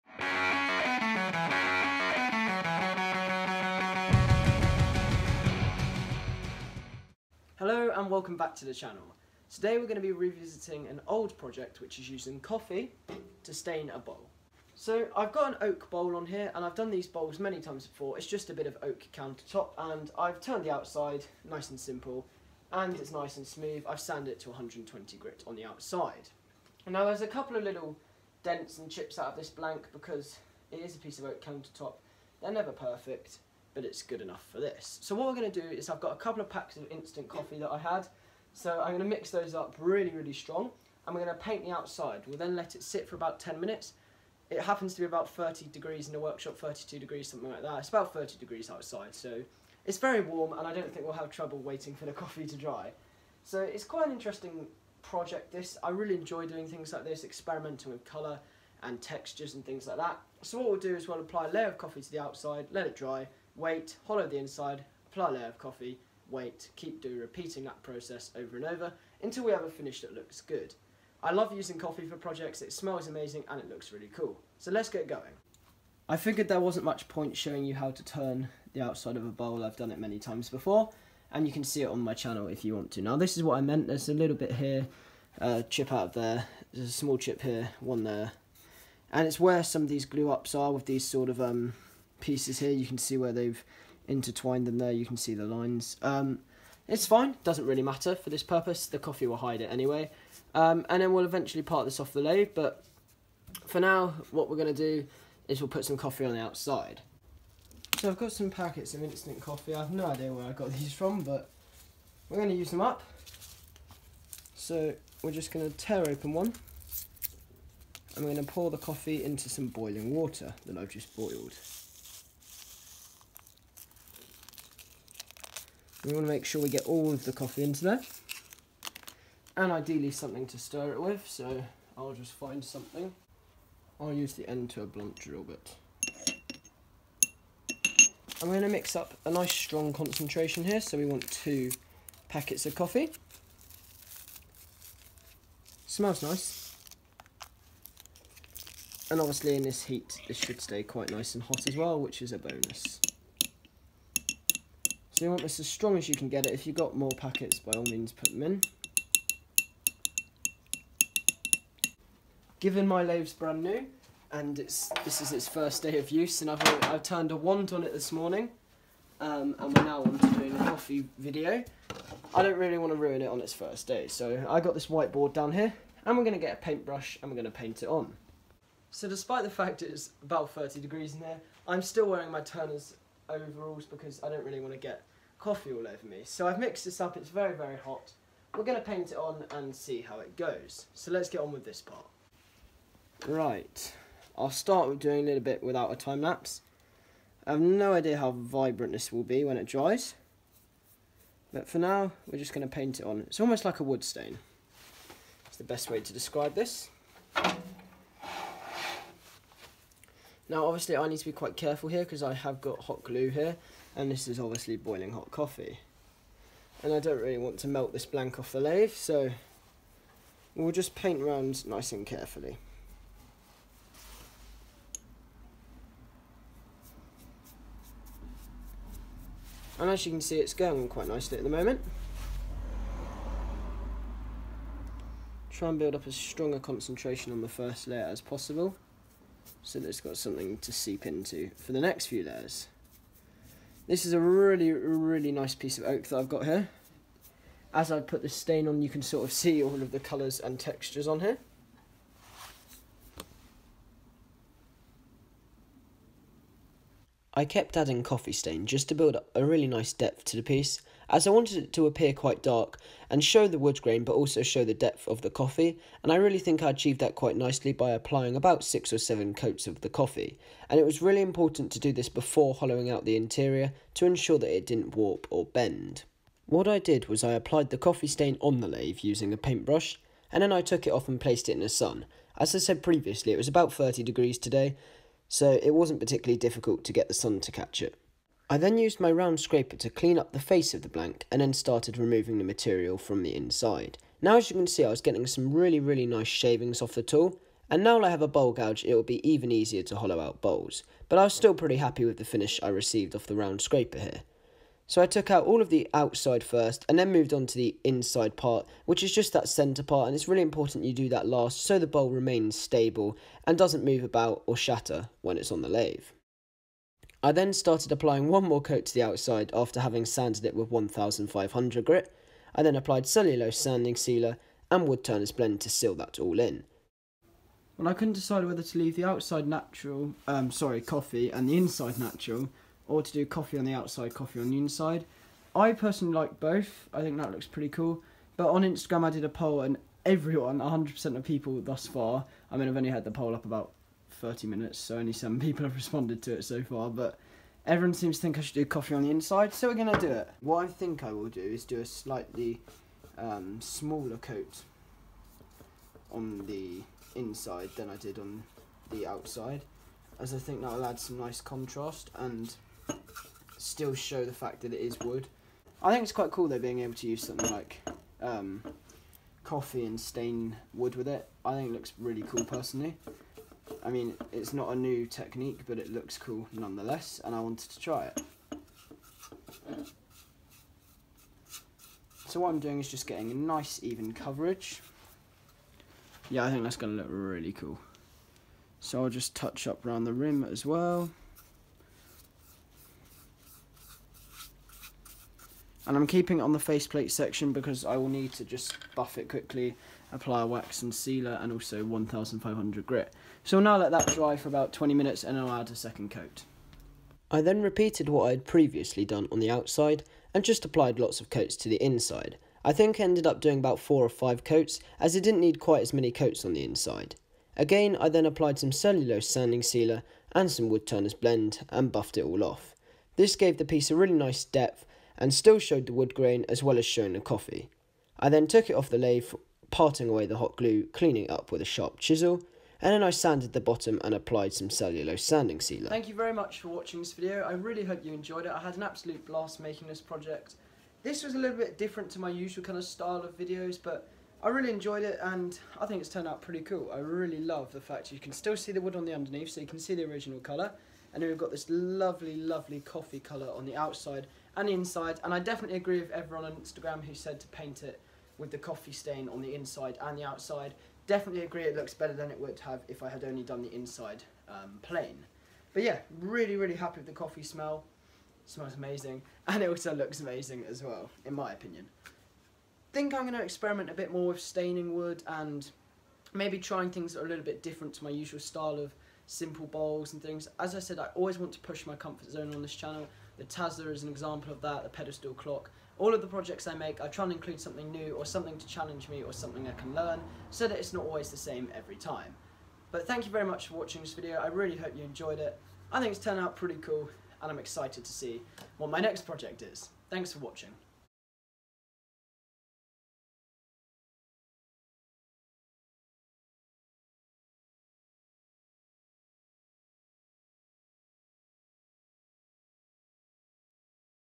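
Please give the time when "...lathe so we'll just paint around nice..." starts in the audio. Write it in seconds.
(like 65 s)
218 s.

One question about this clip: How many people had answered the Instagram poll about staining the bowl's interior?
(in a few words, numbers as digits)
7.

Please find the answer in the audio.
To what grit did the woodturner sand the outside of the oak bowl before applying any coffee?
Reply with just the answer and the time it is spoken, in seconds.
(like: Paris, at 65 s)
120 grit, at 24 s.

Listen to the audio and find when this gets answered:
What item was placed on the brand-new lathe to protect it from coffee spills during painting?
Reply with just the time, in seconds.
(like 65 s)
174 s.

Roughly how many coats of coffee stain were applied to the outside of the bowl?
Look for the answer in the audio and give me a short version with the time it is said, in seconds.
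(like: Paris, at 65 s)
6 or 7, at 268 s.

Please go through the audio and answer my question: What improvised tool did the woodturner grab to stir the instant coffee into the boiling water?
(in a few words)
Blunt drill bit.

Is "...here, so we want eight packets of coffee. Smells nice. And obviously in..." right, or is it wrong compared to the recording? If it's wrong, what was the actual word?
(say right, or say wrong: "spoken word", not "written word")
wrong: "two", not "eight".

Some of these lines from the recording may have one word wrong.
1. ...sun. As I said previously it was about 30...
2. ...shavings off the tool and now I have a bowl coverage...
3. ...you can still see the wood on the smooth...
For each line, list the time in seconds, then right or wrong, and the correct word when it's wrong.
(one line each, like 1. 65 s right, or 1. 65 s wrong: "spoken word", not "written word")
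1. 281 s right
2. 296 s wrong: "gouge", not "coverage"
3. 448 s wrong: "underneath", not "smooth".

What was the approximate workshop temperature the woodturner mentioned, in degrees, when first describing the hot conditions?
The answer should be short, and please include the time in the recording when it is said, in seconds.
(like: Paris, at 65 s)
32 degrees, at 46 s.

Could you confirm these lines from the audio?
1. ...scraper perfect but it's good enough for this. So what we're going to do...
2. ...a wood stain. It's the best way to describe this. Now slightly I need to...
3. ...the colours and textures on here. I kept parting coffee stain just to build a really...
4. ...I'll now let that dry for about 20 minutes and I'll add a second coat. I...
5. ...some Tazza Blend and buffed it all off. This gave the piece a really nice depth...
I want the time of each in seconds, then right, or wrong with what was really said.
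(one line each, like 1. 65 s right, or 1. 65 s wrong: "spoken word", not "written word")
1. 32 s wrong: "never", not "scraper"
2. 203 s wrong: "obviously", not "slightly"
3. 249 s wrong: "adding", not "parting"
4. 403 s right
5. 420 s wrong: "Woodturners", not "Tazza".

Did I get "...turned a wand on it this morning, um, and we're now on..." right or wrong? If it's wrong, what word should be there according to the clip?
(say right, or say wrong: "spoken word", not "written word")
right.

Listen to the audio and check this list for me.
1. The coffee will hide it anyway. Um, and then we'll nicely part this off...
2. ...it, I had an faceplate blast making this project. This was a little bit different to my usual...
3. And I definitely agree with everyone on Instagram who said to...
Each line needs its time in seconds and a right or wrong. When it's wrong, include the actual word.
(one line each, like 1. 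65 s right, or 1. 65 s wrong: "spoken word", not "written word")
1. 98 s wrong: "eventually", not "nicely"
2. 438 s wrong: "absolute", not "faceplate"
3. 455 s right.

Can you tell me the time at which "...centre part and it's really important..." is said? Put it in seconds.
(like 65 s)
309 s.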